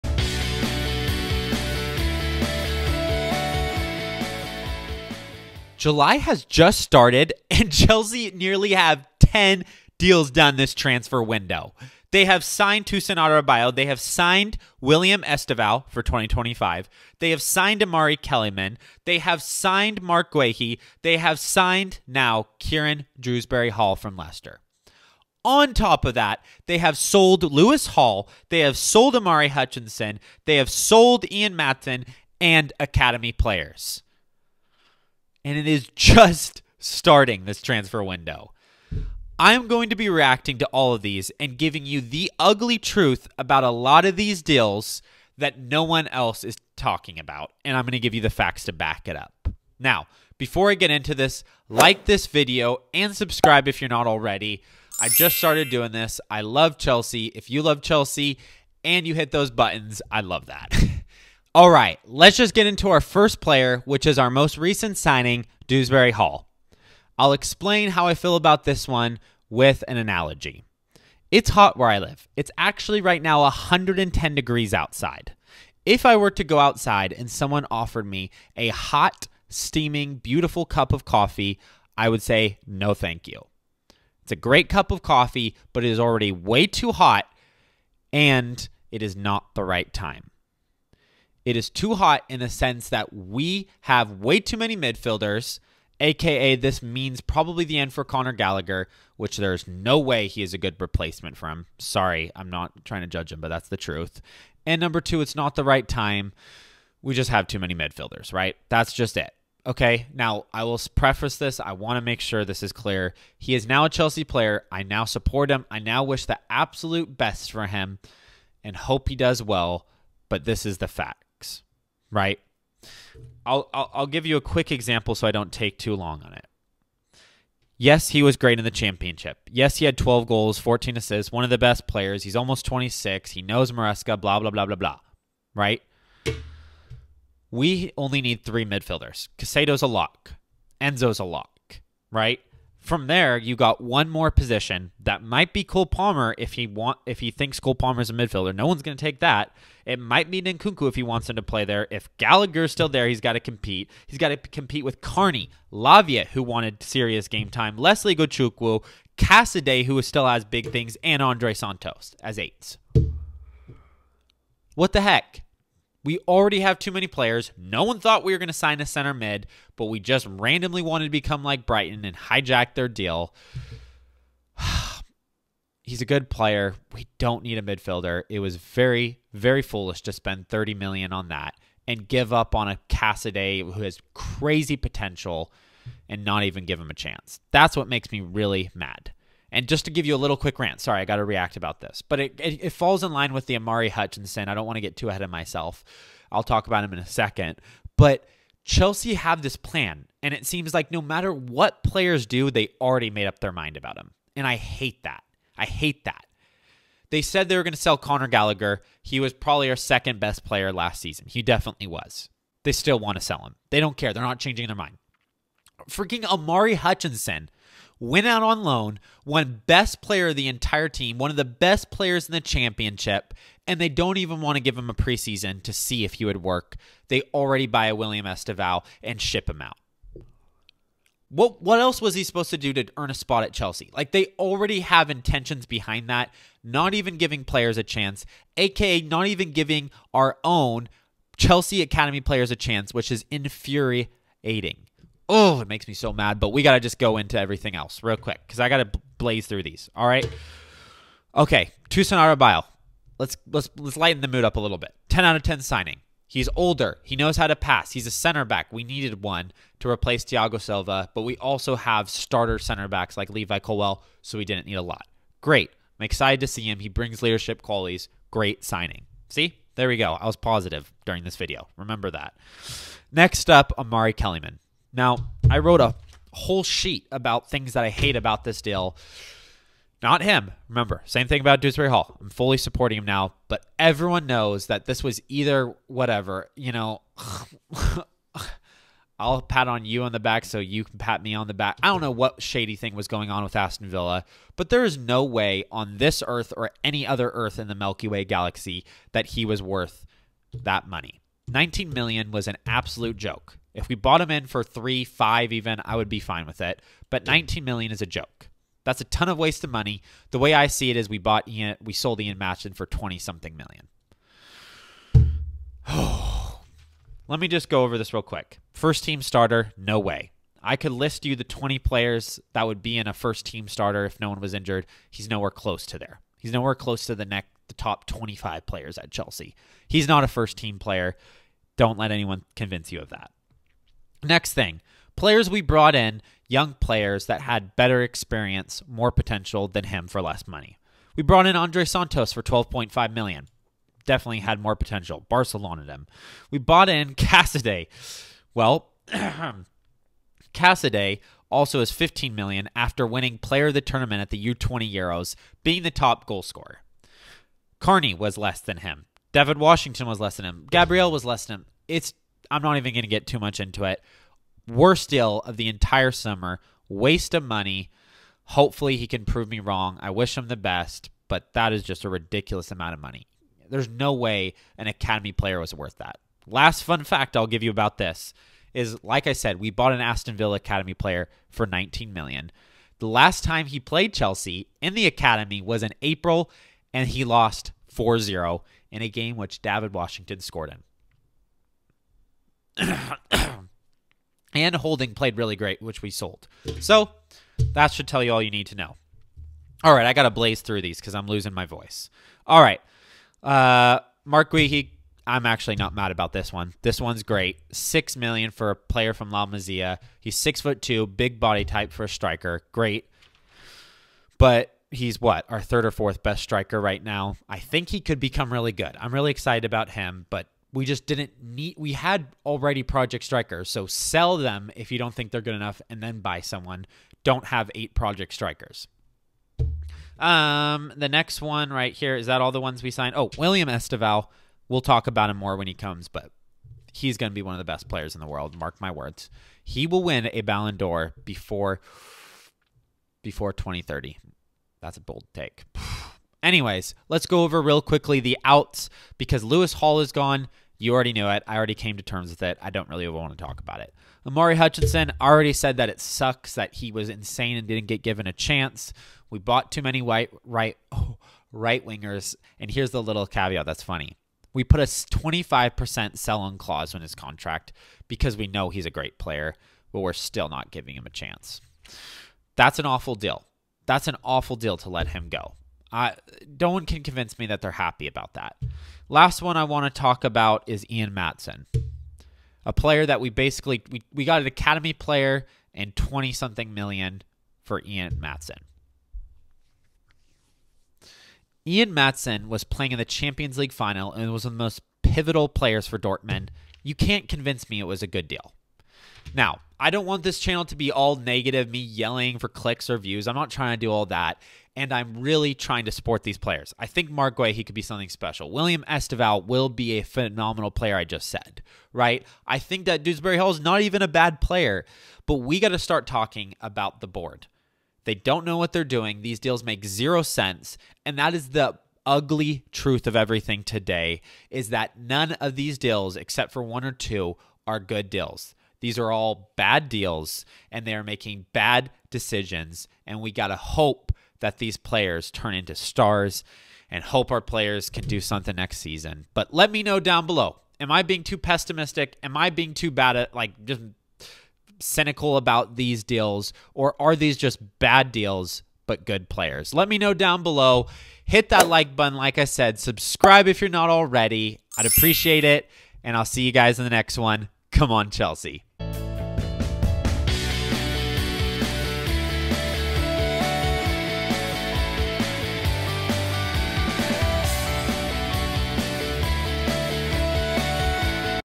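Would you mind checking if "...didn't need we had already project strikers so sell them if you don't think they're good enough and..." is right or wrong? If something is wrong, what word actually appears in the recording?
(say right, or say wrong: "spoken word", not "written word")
right.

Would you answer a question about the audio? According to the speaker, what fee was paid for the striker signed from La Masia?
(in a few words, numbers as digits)
6 million.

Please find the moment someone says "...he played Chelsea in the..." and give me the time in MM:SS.
06:23.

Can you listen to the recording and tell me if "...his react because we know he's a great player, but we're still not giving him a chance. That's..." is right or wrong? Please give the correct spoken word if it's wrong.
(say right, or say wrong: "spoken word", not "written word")
wrong: "contract", not "react".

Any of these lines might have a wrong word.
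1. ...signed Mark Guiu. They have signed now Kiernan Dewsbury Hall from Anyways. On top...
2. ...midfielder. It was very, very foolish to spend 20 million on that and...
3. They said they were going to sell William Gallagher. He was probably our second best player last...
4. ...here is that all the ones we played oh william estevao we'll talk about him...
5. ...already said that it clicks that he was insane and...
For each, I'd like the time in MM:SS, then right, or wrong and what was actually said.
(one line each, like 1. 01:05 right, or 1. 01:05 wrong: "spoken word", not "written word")
1. 00:19 wrong: "Leicester", not "Anyways"
2. 02:57 wrong: "30", not "20"
3. 03:27 wrong: "Conor", not "William"
4. 07:11 wrong: "signed", not "played"
5. 07:35 wrong: "sucks", not "clicks".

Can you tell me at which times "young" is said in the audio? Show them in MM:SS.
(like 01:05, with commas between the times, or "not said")
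05:36.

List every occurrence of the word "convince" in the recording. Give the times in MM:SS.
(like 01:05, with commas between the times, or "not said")
05:32, 07:57, 08:17.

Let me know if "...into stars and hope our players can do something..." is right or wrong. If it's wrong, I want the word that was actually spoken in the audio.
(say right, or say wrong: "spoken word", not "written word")
right.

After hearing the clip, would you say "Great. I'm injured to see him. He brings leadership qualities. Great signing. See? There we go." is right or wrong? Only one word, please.
wrong.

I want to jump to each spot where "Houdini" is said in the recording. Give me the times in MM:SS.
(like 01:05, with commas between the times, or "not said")
not said.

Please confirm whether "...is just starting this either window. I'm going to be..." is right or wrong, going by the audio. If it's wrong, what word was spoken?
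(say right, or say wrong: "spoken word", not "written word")
wrong: "transfer", not "either".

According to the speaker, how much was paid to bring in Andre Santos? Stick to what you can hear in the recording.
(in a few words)
12.5 million.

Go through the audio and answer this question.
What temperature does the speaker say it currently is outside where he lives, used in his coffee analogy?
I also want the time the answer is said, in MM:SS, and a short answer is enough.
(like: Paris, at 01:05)
110 degrees, at 01:13.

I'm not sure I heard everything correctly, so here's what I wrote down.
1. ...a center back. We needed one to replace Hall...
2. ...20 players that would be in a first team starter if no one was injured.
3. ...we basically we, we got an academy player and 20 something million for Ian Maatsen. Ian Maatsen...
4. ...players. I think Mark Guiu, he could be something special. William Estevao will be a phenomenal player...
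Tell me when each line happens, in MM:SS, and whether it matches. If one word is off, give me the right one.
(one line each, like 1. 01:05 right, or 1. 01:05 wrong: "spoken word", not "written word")
1. 04:18 wrong: "Thiago", not "Hall"
2. 05:21 right
3. 08:03 right
4. 08:26 right.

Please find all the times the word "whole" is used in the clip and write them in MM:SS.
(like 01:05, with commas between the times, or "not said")
04:36.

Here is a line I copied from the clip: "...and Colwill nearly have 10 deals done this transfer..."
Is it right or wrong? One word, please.
wrong.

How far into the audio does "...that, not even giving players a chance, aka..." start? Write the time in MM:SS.
03:56.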